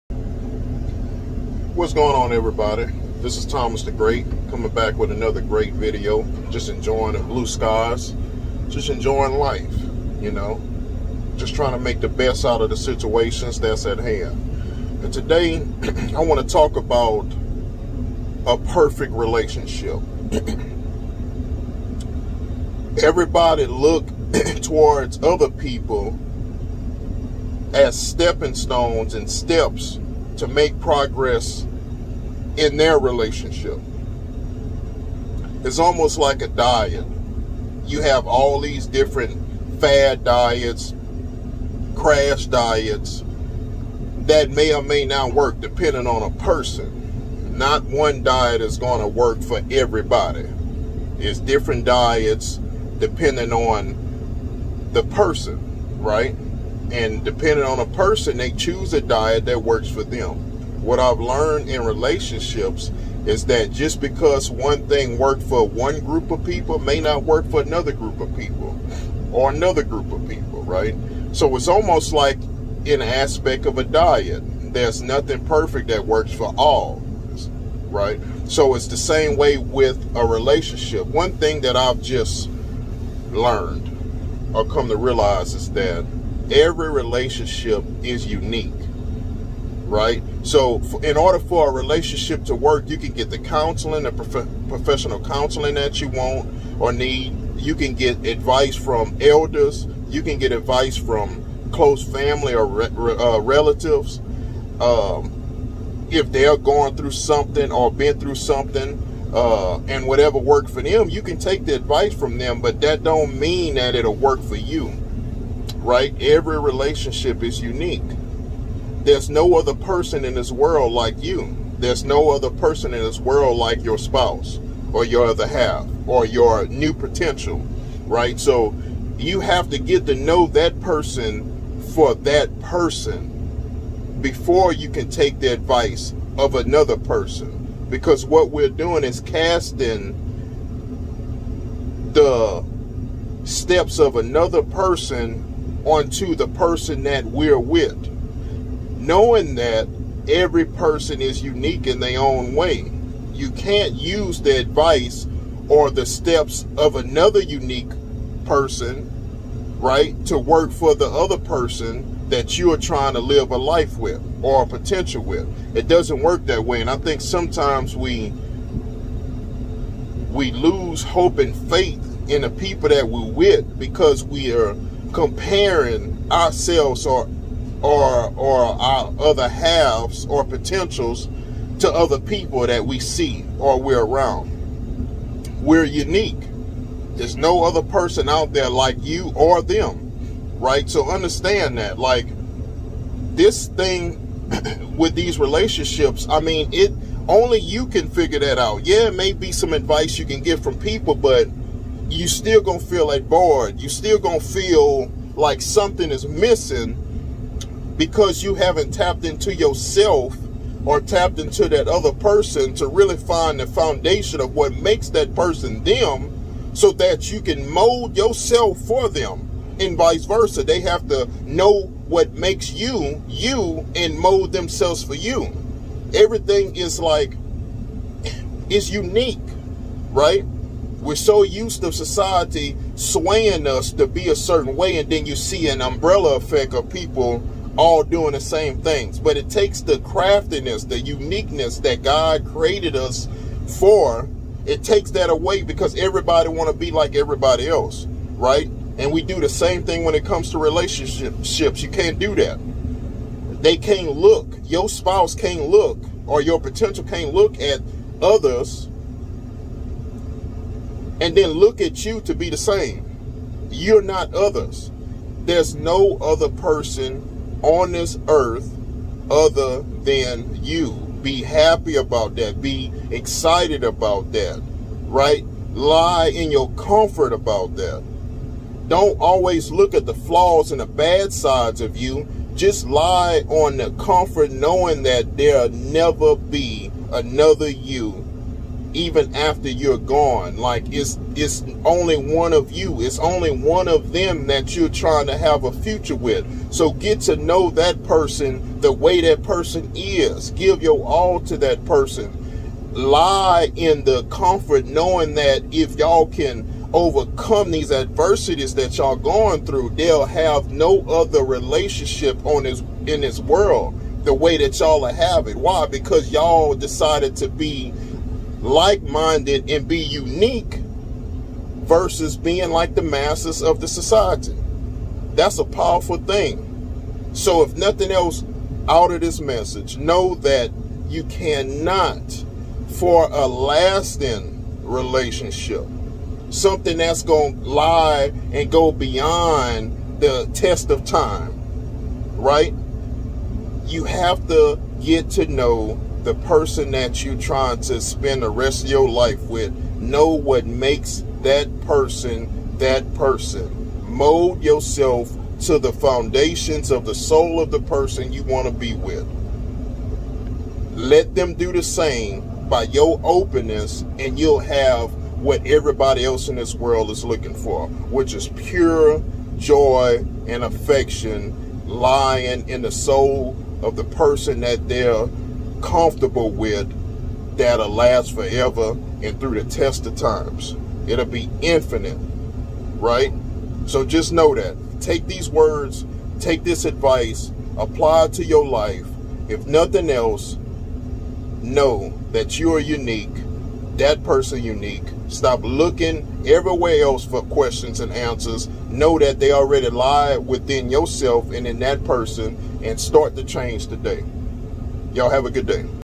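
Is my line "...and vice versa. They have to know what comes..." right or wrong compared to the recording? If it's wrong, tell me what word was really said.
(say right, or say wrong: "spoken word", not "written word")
wrong: "makes", not "comes".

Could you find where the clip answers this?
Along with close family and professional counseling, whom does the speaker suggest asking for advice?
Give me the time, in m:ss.
1:39.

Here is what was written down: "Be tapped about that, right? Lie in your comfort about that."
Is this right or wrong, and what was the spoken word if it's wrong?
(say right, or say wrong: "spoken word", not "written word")
wrong: "excited", not "tapped".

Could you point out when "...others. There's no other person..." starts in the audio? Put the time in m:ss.
4:24.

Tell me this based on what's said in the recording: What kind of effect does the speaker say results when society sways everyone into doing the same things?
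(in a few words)
An umbrella effect.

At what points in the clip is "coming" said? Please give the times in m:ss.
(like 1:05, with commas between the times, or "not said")
0:04.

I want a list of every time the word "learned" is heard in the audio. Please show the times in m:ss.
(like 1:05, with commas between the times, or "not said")
1:01, 1:23.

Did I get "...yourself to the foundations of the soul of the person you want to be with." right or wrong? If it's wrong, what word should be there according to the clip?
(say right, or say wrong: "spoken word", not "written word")
right.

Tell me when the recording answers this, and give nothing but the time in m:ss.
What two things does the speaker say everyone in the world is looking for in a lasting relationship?
6:08.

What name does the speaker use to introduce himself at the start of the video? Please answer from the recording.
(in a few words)
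Thomas the Great.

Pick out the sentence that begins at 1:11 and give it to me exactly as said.
So it's almost like an aspect of a diet.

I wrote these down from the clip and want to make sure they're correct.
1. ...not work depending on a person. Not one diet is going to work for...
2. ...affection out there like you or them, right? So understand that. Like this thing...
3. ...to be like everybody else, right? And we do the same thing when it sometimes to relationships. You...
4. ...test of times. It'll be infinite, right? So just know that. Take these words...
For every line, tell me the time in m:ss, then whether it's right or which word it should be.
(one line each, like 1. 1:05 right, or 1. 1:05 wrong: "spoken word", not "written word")
1. 0:45 right
2. 3:07 wrong: "person", not "affection"
3. 4:06 wrong: "comes", not "sometimes"
4. 6:19 right.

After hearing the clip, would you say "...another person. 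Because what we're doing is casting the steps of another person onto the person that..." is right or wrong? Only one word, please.
right.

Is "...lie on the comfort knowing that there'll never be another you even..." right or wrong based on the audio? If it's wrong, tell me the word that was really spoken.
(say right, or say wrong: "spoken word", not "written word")
right.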